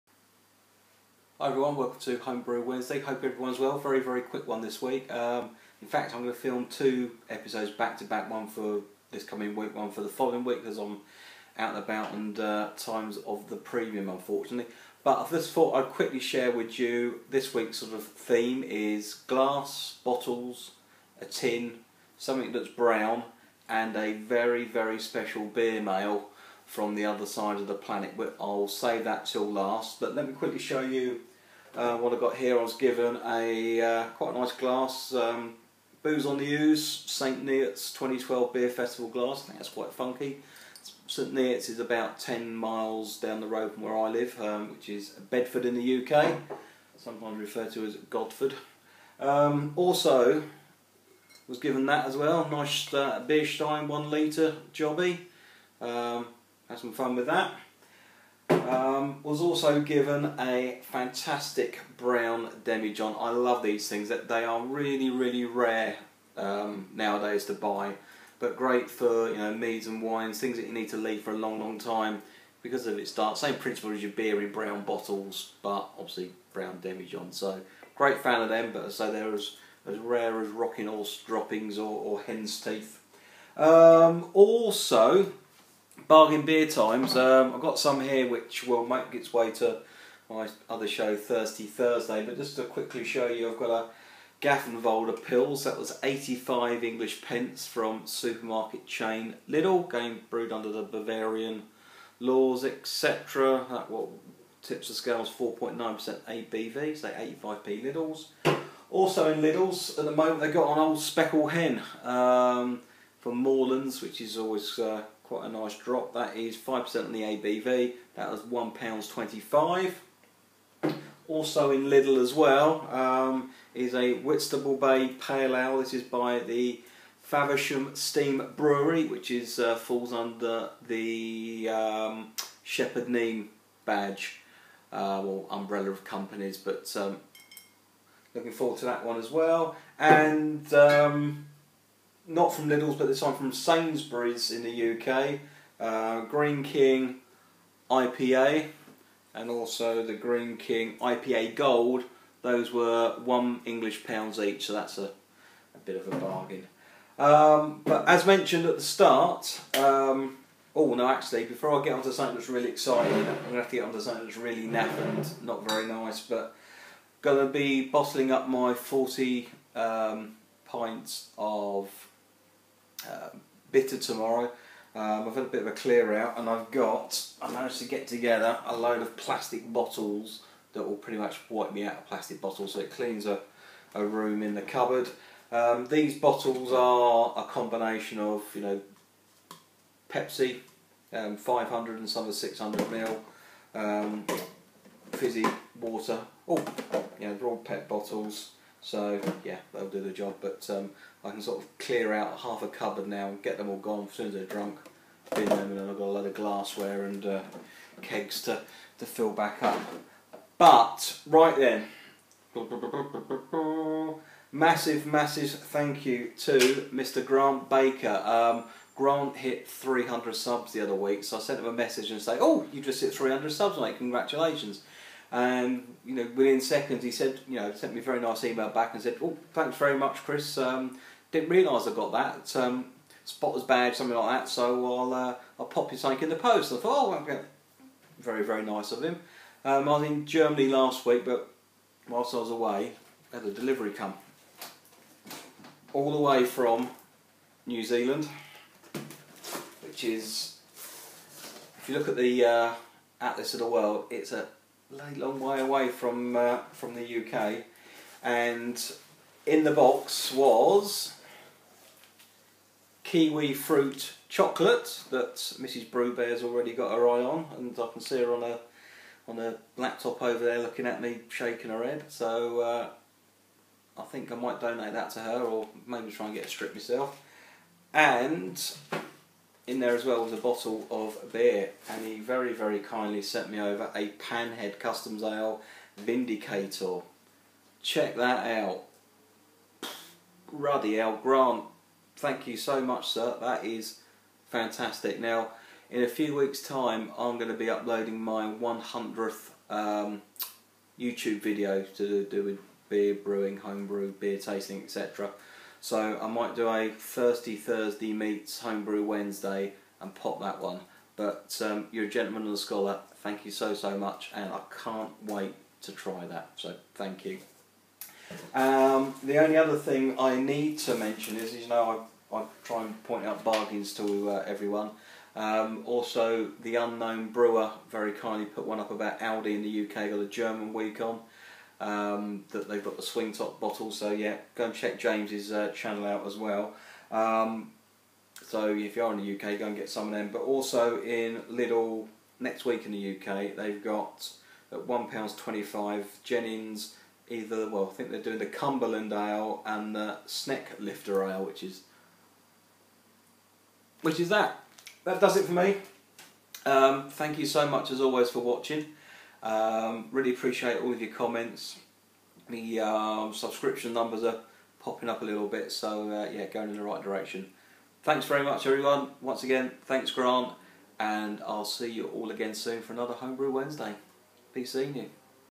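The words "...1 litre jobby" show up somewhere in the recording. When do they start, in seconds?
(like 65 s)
53 s.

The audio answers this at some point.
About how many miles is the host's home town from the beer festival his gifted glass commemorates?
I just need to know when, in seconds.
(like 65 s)
42 s.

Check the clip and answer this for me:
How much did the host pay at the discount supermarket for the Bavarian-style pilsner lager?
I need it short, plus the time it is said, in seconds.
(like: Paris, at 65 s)
85p, at 96 s.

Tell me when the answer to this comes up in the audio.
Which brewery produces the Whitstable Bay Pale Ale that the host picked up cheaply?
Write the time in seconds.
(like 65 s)
127 s.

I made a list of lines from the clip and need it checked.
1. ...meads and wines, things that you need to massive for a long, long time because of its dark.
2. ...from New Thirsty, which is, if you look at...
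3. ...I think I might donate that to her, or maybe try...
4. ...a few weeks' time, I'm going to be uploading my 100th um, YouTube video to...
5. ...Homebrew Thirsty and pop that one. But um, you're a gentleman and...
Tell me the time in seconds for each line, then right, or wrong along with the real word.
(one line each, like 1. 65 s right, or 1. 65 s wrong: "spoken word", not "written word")
1. 69 s wrong: "leave", not "massive"
2. 246 s wrong: "Zealand", not "Thirsty"
3. 273 s right
4. 296 s right
5. 308 s wrong: "Wednesday", not "Thirsty".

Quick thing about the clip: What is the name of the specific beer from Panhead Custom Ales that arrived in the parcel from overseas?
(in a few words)
Vindicator.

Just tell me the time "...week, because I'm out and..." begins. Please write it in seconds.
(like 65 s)
10 s.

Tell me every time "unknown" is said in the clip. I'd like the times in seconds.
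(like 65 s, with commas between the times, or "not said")
326 s.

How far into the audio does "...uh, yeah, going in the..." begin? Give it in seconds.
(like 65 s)
366 s.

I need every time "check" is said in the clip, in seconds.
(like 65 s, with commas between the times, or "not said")
287 s, 334 s.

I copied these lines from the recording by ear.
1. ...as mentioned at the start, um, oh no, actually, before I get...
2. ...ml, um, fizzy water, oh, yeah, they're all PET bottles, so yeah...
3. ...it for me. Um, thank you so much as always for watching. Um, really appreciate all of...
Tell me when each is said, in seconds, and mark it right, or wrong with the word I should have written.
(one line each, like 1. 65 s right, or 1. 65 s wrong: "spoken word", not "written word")
1. 158 s right
2. 192 s right
3. 355 s right.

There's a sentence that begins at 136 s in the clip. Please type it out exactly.
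But um, looking forward to that one as well.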